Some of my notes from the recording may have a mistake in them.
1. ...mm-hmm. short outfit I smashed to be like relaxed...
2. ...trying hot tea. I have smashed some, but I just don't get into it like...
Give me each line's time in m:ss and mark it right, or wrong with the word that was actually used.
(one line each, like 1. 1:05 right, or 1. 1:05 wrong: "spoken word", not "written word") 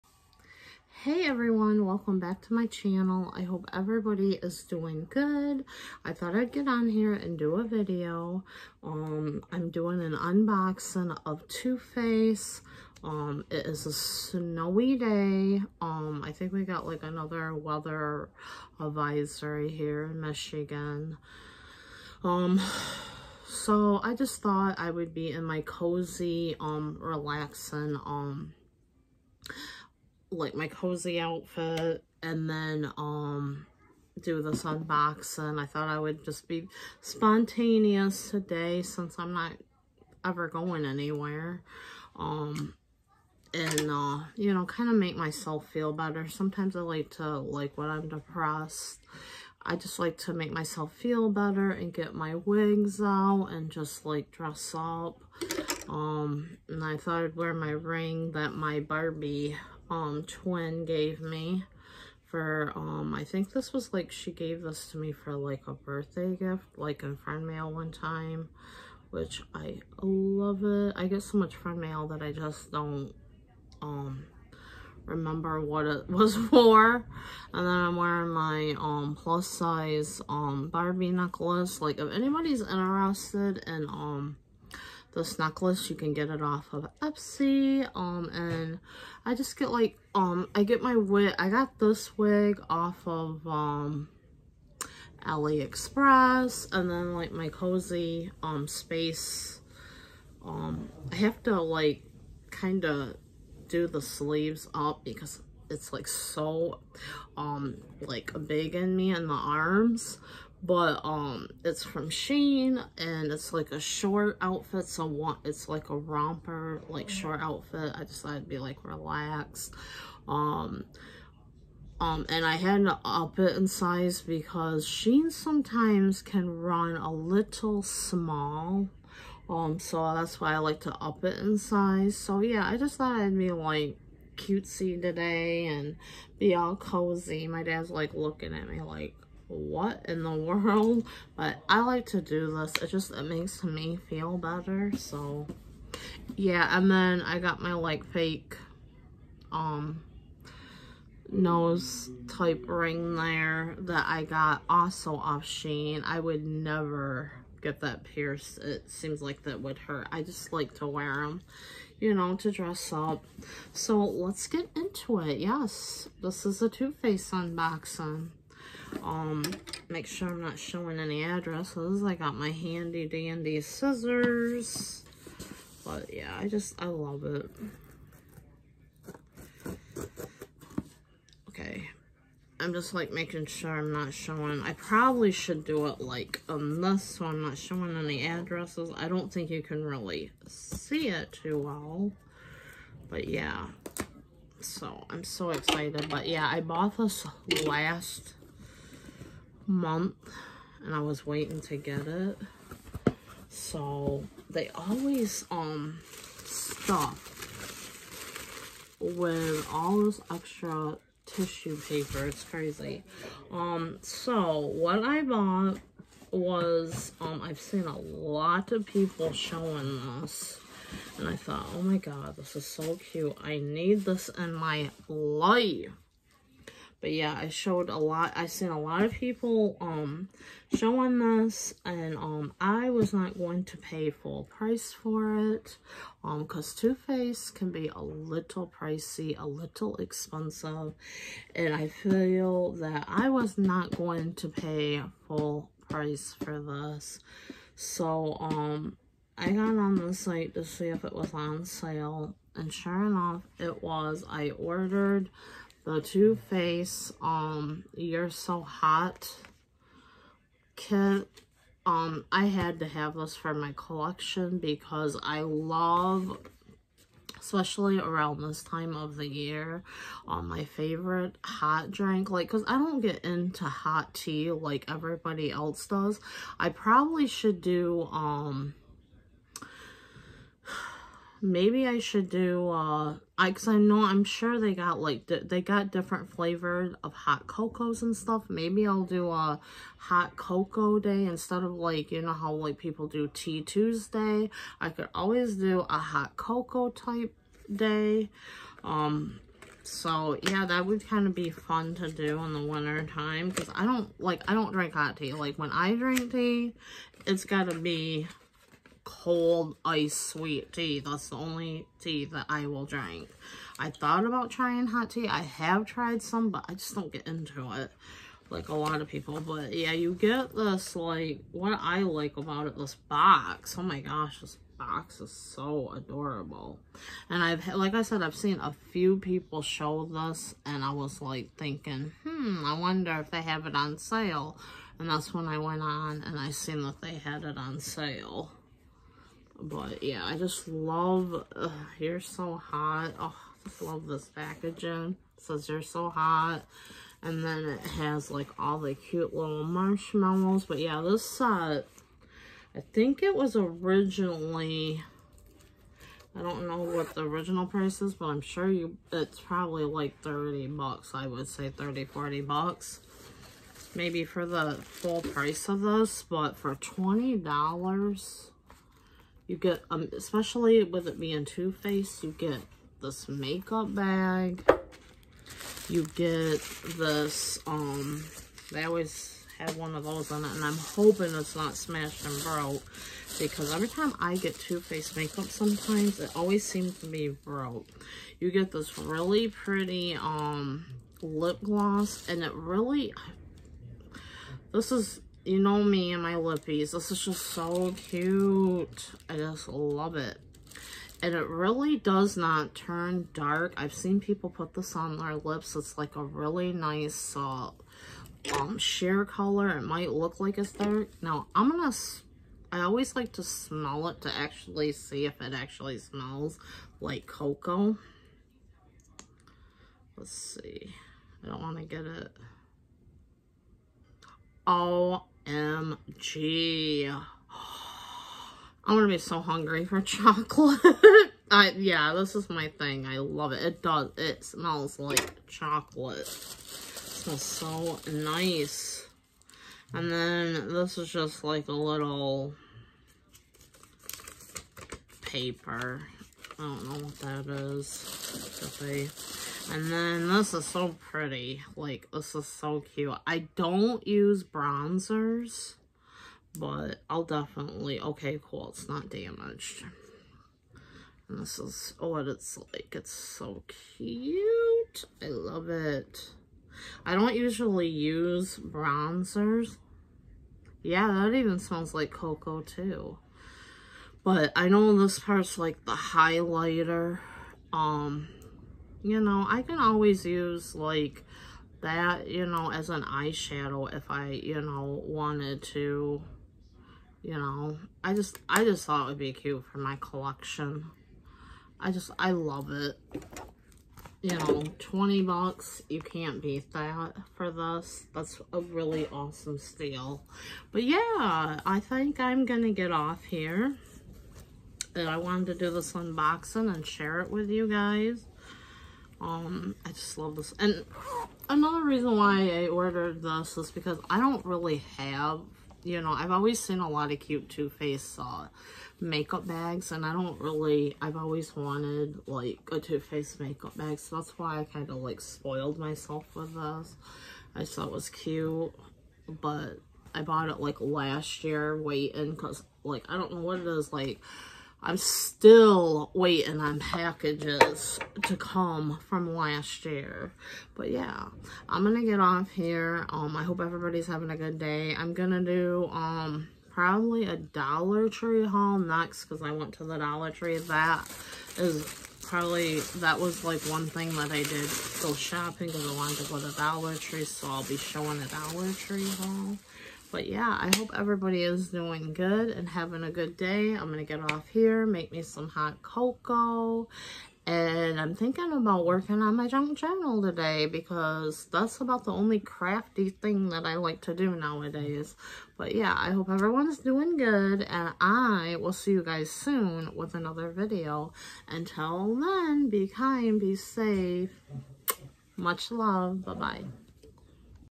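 1. 1:57 wrong: "decided", not "smashed"
2. 5:14 wrong: "tried", not "smashed".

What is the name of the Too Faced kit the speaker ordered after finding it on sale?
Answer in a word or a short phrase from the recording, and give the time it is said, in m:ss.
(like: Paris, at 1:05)
You're So Hot kit, at 4:17.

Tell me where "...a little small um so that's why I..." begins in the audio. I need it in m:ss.
2:06.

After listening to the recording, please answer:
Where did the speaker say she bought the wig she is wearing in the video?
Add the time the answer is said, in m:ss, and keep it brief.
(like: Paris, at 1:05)
AliExpress, at 1:35.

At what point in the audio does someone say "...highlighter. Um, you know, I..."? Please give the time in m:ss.
7:55.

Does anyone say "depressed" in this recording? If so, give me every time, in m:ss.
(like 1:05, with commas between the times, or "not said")
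0:48.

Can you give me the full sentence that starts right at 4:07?
So um I got on the site to see if it was on sale, and sure enough, it was.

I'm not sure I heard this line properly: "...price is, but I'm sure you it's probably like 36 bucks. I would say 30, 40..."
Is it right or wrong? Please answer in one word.
wrong.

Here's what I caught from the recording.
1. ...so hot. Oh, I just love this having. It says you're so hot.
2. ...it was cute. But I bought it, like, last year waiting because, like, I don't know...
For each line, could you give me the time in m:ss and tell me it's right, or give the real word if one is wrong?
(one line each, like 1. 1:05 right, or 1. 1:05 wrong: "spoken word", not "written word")
1. 5:42 wrong: "packaging", not "having"
2. 8:47 right.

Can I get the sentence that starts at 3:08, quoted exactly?
I don't think you can really see it too well.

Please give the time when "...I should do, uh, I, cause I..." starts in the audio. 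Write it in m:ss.
4:41.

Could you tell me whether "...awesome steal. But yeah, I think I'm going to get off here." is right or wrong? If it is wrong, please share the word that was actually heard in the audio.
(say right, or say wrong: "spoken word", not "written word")
right.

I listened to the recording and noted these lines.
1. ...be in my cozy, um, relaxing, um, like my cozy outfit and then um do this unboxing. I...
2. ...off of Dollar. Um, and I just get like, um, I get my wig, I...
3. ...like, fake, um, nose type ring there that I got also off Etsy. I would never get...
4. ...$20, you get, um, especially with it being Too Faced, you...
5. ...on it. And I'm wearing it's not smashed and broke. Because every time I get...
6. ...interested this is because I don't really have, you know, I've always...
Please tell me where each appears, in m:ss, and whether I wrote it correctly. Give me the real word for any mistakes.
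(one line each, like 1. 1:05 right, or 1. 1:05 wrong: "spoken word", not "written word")
1. 0:25 right
2. 1:26 wrong: "Etsy", not "Dollar"
3. 2:27 wrong: "Shein", not "Etsy"
4. 6:06 right
5. 6:20 wrong: "hoping", not "wearing"
6. 8:32 wrong: "ordered", not "interested".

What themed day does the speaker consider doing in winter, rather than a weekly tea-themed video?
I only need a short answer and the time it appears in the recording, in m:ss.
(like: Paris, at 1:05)
hot cocoa day, at 4:49.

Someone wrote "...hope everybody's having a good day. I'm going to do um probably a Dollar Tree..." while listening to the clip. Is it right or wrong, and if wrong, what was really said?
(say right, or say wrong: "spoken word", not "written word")
right.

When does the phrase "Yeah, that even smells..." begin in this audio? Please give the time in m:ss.
7:50.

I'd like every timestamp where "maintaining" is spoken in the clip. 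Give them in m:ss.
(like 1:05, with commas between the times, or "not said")
not said.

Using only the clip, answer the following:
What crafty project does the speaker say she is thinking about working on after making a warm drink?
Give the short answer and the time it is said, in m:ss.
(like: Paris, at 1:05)
junk journal, at 9:29.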